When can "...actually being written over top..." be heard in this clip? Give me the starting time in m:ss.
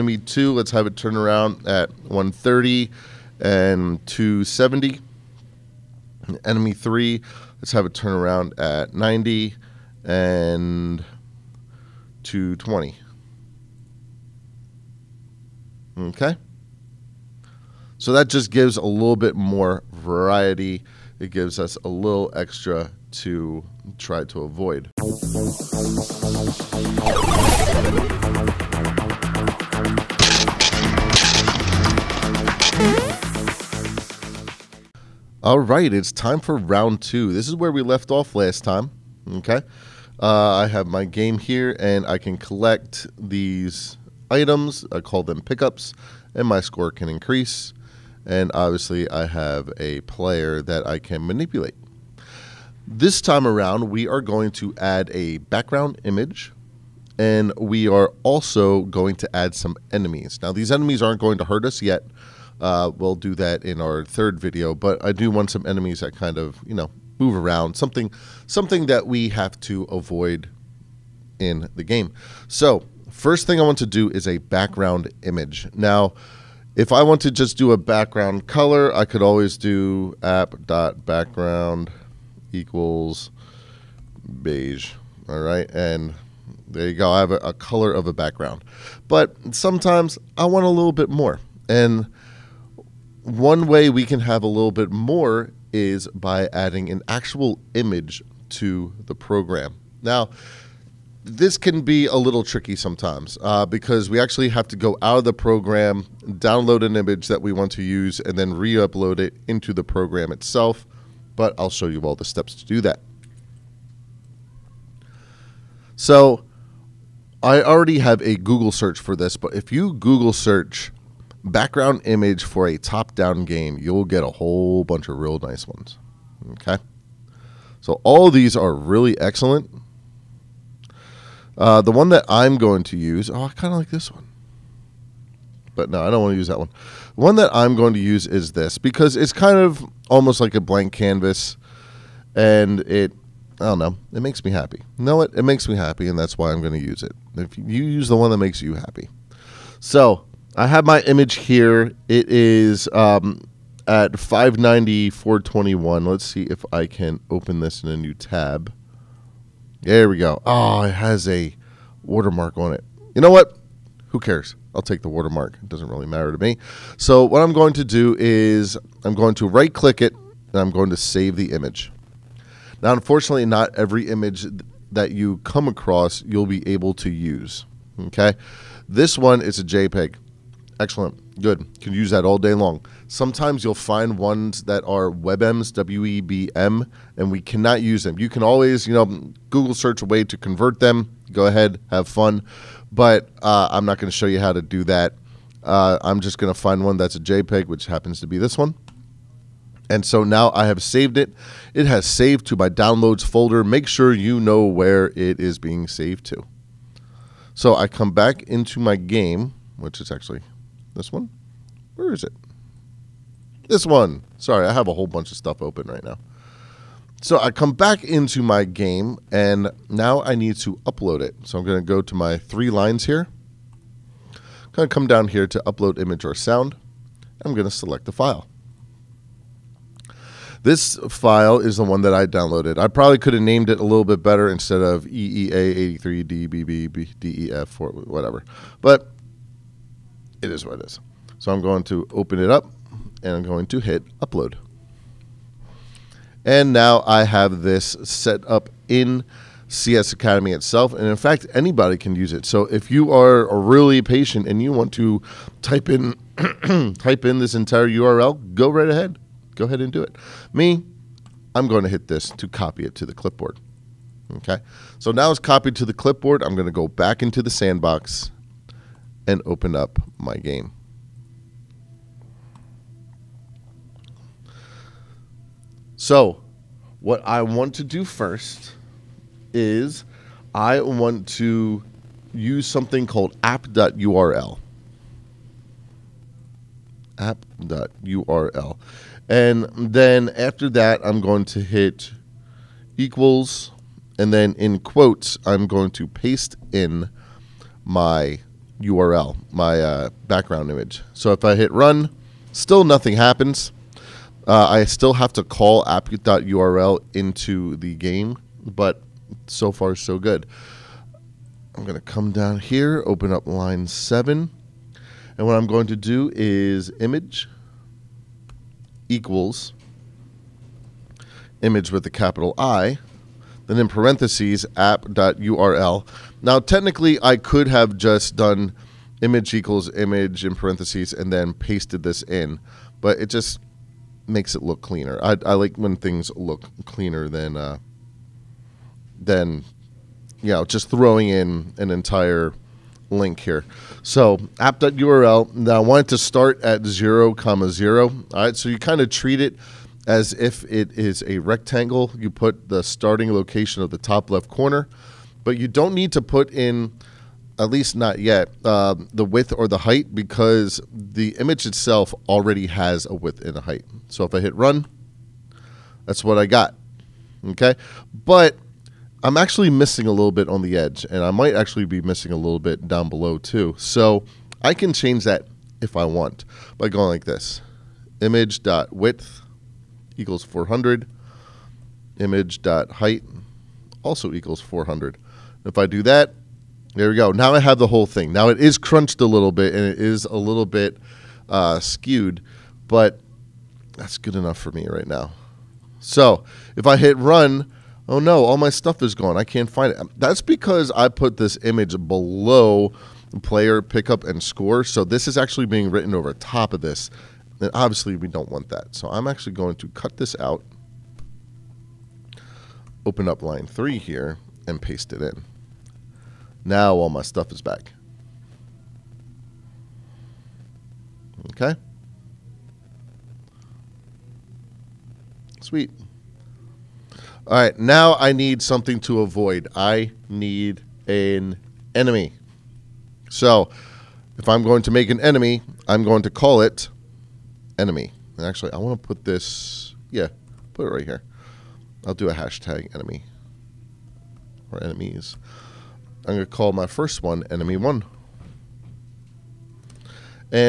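6:45.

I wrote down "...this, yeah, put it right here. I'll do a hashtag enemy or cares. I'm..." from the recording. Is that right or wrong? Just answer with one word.
wrong.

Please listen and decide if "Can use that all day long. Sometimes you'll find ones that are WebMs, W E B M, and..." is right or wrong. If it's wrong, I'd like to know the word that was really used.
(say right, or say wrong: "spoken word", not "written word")
right.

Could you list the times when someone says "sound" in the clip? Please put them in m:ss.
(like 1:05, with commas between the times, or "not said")
3:46.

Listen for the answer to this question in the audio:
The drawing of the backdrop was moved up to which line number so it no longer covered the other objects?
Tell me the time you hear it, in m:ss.
6:53.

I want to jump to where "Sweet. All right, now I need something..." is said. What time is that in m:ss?
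7:05.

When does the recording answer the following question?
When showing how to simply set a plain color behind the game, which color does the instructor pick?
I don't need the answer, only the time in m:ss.
1:24.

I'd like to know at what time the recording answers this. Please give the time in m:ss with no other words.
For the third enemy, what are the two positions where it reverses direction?
0:08.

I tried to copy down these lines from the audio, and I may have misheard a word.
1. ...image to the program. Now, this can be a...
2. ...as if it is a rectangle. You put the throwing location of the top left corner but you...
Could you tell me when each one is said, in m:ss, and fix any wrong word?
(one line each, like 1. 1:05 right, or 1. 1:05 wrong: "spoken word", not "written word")
1. 1:37 right
2. 5:50 wrong: "starting", not "throwing".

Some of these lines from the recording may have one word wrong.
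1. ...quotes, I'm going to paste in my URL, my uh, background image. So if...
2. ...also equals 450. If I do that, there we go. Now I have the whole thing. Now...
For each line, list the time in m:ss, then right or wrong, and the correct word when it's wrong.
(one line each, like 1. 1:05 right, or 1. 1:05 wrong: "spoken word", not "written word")
1. 4:54 right
2. 6:24 wrong: "400", not "450".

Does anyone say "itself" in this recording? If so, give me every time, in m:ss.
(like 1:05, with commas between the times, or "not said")
1:50, 4:10, 6:01.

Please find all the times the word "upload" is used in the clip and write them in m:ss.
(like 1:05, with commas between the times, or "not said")
1:48, 3:40, 3:45, 4:04.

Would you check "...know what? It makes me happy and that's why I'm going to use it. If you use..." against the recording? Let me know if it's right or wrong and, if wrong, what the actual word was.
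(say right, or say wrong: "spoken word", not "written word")
right.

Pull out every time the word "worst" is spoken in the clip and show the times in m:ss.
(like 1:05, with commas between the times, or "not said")
not said.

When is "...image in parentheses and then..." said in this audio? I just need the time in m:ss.
5:29.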